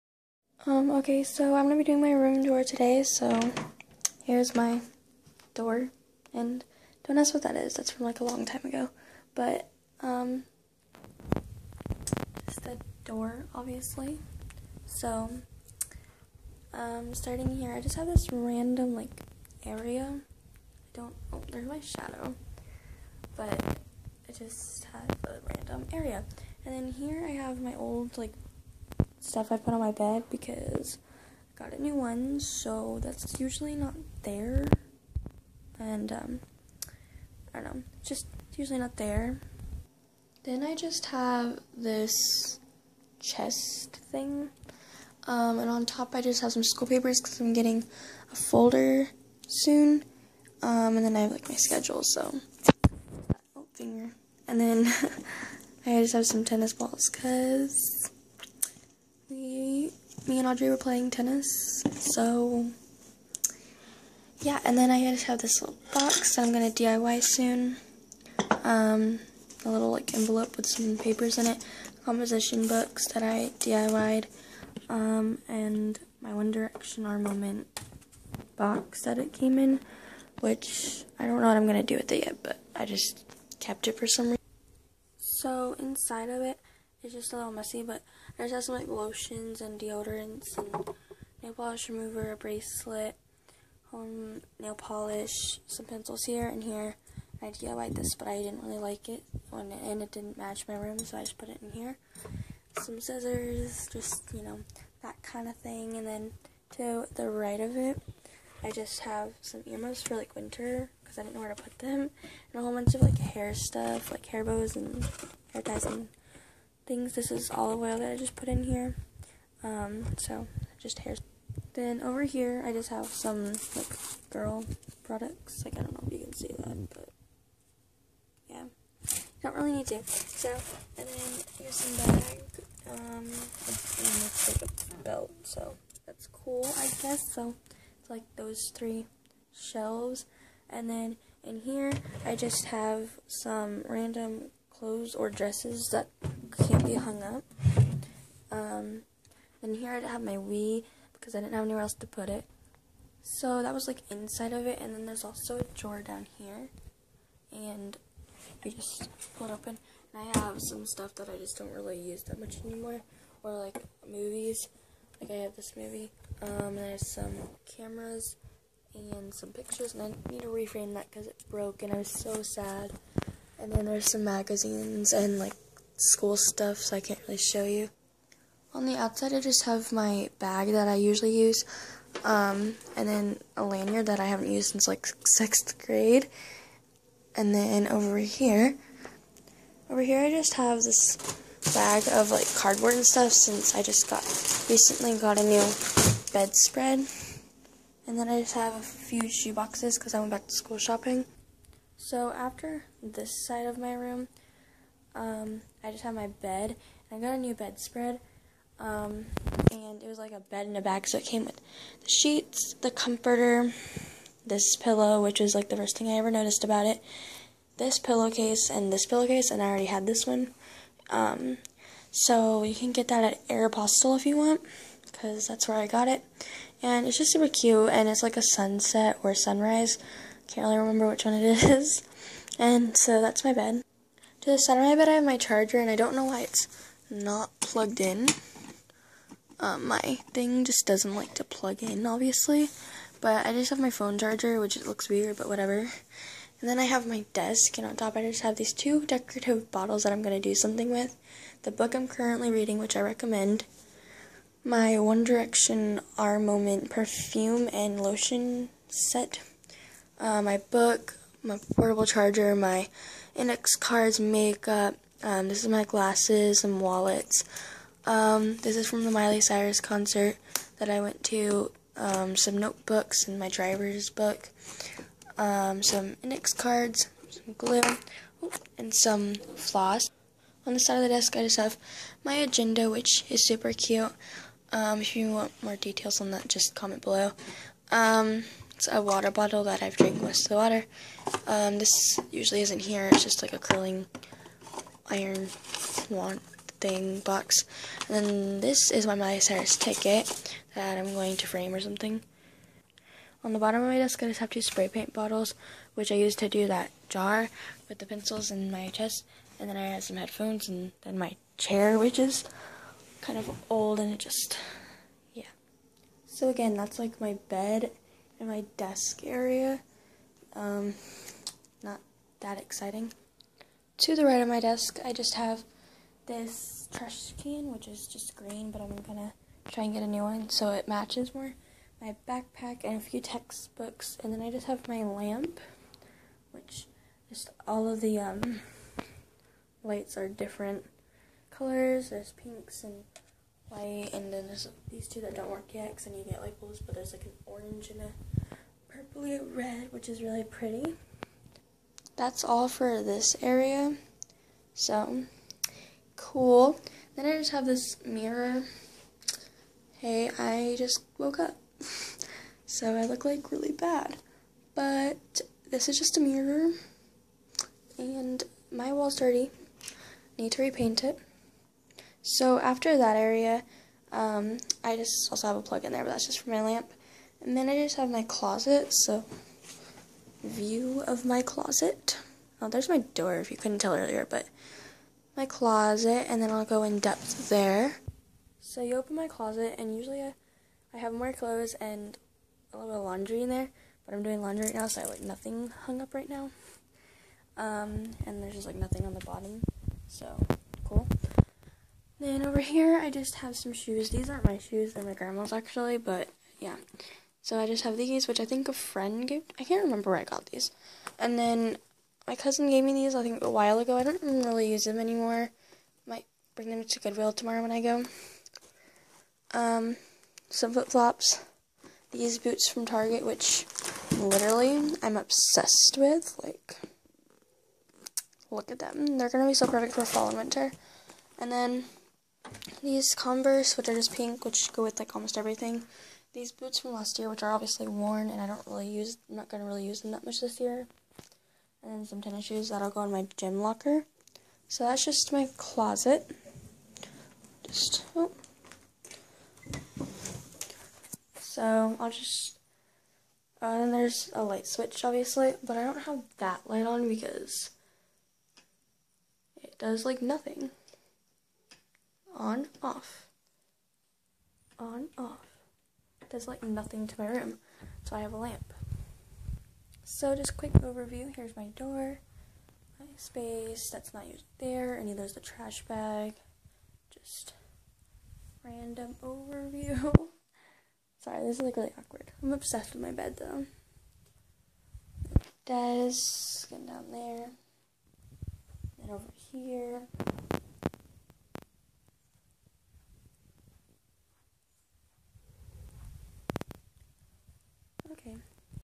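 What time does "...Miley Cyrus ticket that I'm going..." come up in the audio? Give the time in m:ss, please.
4:59.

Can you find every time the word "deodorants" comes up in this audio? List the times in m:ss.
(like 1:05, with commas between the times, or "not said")
1:29.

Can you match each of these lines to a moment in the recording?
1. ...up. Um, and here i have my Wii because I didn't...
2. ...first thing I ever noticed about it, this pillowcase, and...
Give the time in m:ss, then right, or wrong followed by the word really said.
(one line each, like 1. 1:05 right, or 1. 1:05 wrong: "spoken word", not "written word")
1. 2:27 right
2. 3:35 right.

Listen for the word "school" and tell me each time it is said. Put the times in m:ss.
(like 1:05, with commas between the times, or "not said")
0:46, 2:56, 3:20.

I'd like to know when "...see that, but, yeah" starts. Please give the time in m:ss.
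2:06.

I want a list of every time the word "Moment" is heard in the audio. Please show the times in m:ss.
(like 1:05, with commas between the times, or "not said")
1:17, 4:16.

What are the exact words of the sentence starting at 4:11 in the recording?
The book I'm currently reading, which I recommend.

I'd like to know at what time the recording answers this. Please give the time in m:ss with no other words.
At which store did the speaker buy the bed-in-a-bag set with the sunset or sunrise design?
3:43.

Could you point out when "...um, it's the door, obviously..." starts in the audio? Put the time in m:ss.
0:10.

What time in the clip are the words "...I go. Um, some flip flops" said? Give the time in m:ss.
6:57.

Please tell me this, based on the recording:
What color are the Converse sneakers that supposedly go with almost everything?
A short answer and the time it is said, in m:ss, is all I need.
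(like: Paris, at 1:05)
Pink, at 7:14.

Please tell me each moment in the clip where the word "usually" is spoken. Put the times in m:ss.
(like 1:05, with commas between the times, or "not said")
0:33, 0:38, 3:00, 4:52, 6:29.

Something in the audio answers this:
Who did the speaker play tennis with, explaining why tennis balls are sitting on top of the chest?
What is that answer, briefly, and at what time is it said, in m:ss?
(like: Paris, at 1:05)
Audrey, at 1:00.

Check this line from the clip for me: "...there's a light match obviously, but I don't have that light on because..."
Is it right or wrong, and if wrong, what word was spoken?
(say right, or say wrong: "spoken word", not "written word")
wrong: "switch", not "match".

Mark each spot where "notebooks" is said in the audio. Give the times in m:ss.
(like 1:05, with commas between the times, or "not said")
4:32.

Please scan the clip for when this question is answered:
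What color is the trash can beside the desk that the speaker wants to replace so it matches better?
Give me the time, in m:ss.
5:28.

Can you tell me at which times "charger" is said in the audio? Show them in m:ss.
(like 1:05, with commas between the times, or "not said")
3:55, 4:04, 4:22.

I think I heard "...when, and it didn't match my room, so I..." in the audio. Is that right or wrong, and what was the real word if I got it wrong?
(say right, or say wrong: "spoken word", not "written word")
right.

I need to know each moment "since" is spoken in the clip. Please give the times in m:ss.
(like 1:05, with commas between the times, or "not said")
3:04, 3:13.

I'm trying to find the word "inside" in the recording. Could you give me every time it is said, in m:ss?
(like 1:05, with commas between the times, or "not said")
1:25, 2:34.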